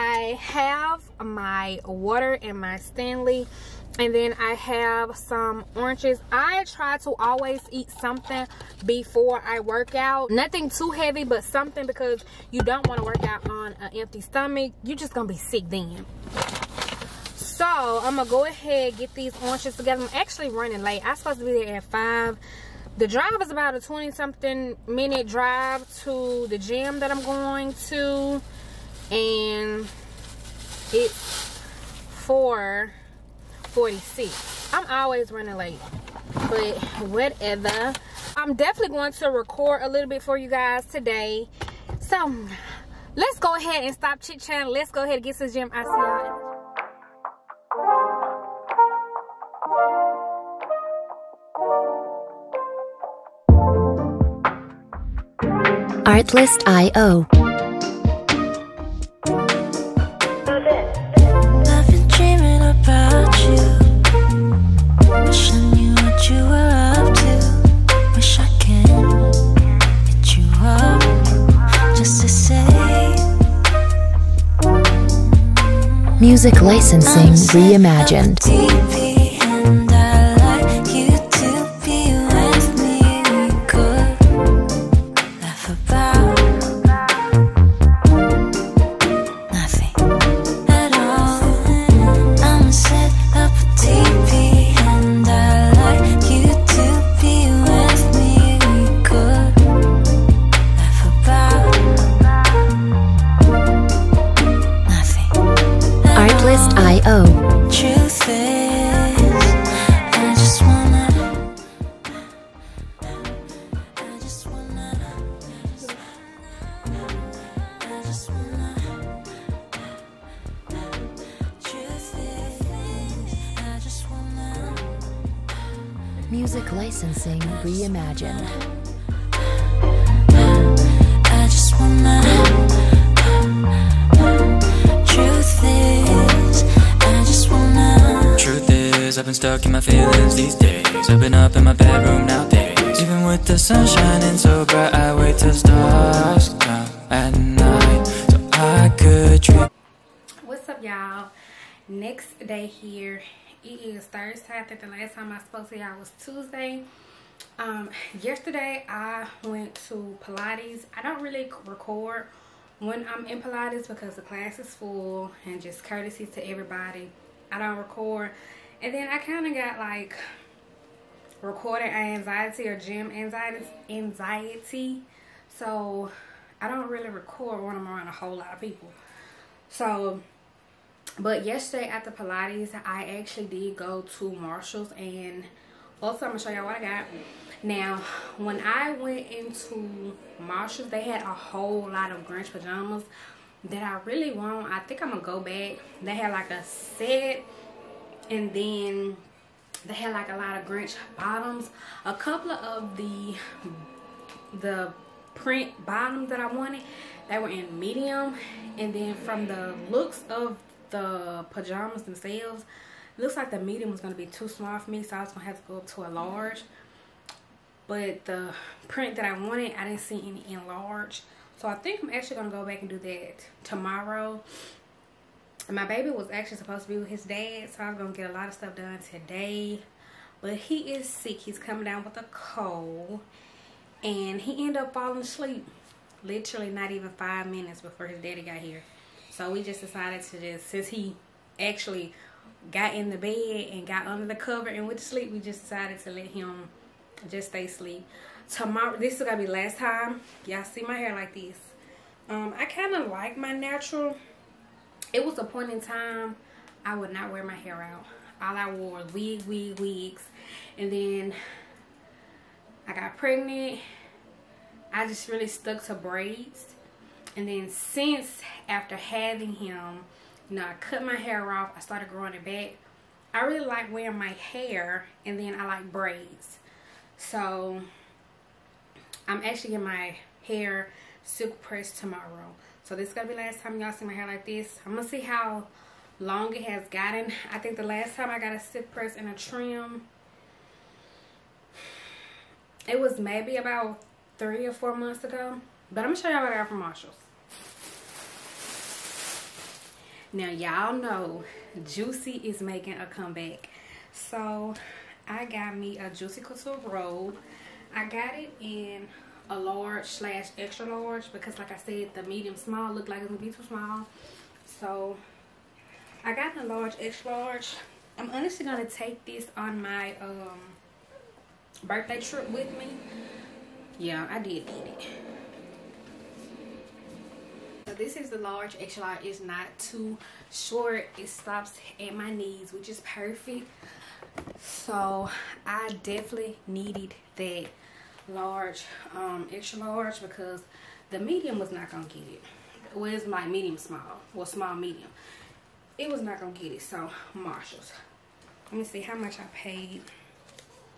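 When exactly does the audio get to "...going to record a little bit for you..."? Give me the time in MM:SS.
00:38.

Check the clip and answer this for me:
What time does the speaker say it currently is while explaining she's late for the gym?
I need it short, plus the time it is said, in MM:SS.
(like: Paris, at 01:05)
4:46, at 00:32.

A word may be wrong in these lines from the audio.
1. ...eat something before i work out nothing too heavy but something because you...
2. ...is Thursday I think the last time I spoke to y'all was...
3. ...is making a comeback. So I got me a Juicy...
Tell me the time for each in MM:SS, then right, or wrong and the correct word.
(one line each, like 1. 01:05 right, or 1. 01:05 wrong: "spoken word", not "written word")
1. 00:07 right
2. 02:33 right
3. 05:02 right.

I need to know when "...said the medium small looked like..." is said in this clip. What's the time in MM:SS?
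05:11.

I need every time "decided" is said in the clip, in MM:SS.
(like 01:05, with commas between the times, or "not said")
03:59, 04:05.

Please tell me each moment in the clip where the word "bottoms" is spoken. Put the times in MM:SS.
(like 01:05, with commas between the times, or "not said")
03:21, 03:25.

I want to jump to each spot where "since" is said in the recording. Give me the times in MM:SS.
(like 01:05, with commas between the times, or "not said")
04:00, 04:27.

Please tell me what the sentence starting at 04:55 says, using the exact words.
But I'm going to show y'all what I got from Marshalls.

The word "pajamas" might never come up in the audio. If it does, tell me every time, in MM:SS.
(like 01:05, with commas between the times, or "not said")
03:12, 03:31.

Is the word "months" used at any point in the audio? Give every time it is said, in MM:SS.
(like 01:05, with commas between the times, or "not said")
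04:54.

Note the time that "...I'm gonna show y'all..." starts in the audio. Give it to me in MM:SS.
03:06.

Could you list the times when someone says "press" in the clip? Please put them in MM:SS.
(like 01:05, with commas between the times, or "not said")
04:41, 04:48.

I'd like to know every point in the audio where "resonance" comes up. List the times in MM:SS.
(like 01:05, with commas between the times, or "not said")
not said.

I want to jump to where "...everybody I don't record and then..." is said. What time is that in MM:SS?
02:46.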